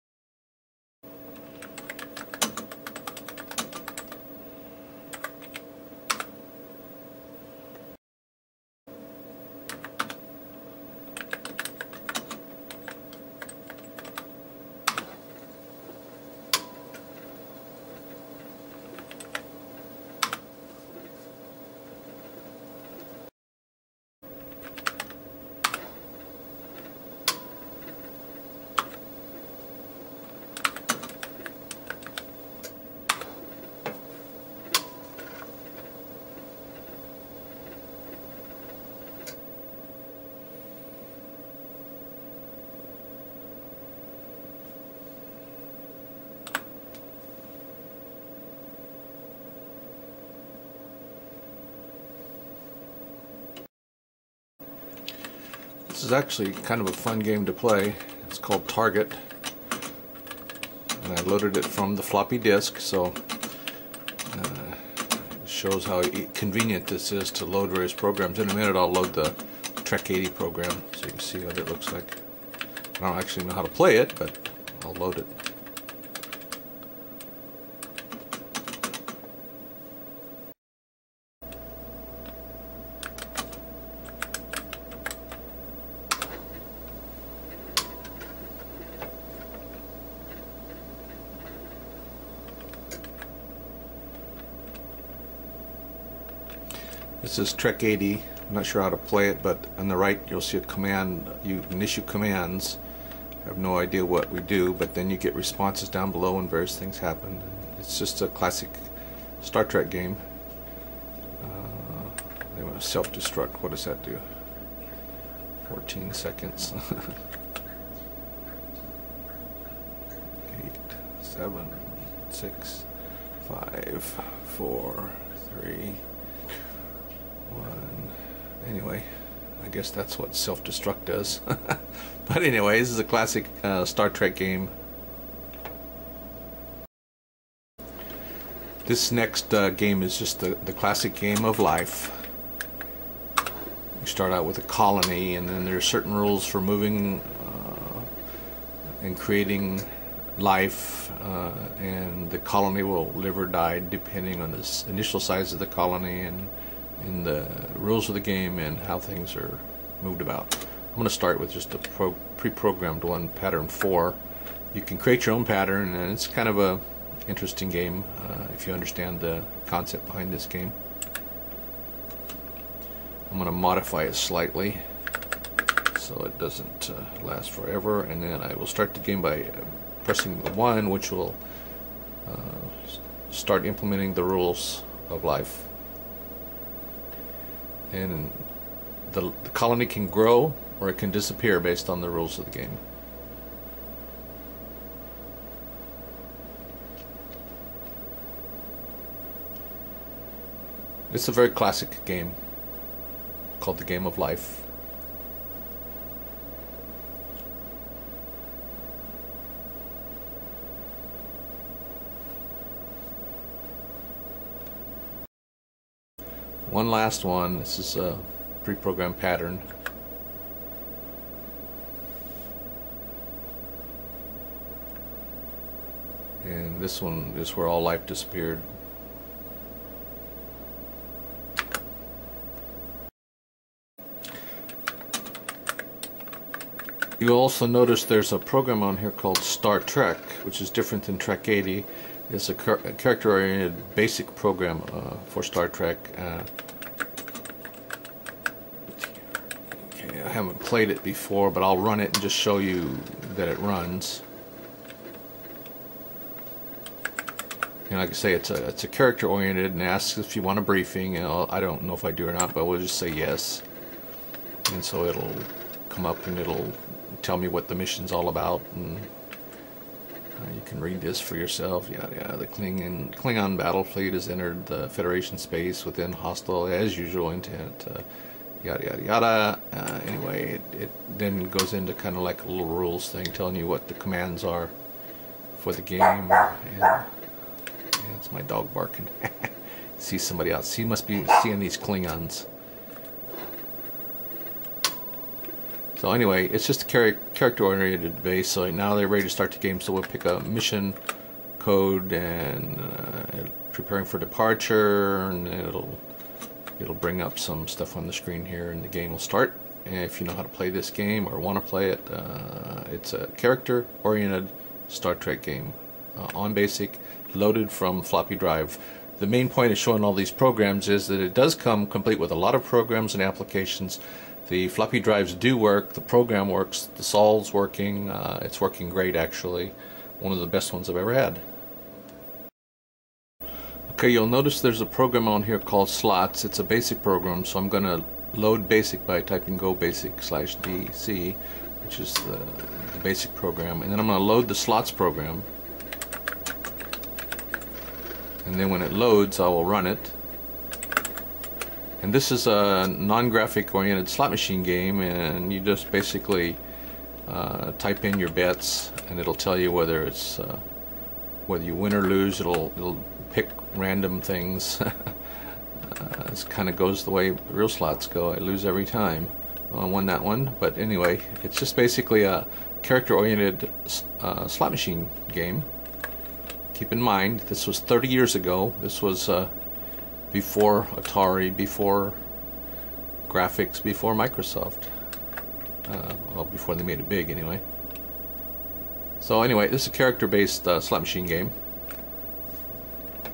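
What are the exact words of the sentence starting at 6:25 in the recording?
Uh, well, before they made it big, anyway.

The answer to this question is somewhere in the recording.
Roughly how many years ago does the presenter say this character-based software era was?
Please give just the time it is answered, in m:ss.
6:17.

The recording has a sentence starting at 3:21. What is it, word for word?
It's a very classic game called The Game of Life.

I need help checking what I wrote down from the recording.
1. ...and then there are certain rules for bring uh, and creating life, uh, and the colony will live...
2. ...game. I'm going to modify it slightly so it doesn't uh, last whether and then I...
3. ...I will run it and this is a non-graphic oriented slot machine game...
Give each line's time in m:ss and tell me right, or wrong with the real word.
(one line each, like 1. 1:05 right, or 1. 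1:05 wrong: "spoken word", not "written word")
1. 2:25 wrong: "moving", not "bring"
2. 2:50 wrong: "forever", not "whether"
3. 5:49 right.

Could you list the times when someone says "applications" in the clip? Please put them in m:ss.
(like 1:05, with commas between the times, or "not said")
5:23.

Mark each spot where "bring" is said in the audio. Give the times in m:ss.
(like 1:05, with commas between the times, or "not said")
5:06.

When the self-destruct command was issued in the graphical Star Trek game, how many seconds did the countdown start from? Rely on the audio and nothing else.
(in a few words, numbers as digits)
14.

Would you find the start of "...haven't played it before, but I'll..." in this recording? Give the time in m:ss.
4:10.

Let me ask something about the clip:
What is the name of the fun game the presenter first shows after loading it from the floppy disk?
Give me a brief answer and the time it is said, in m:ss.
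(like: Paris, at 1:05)
Target, at 0:58.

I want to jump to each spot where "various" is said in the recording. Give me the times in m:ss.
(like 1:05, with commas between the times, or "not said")
1:07, 1:46.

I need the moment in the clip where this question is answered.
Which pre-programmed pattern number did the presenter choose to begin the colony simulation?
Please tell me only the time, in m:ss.
2:43.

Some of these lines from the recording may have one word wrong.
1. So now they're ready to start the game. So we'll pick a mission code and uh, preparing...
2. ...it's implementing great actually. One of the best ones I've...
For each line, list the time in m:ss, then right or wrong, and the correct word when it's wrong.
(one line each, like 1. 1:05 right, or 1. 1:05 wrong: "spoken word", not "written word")
1. 4:58 right
2. 5:28 wrong: "working", not "implementing".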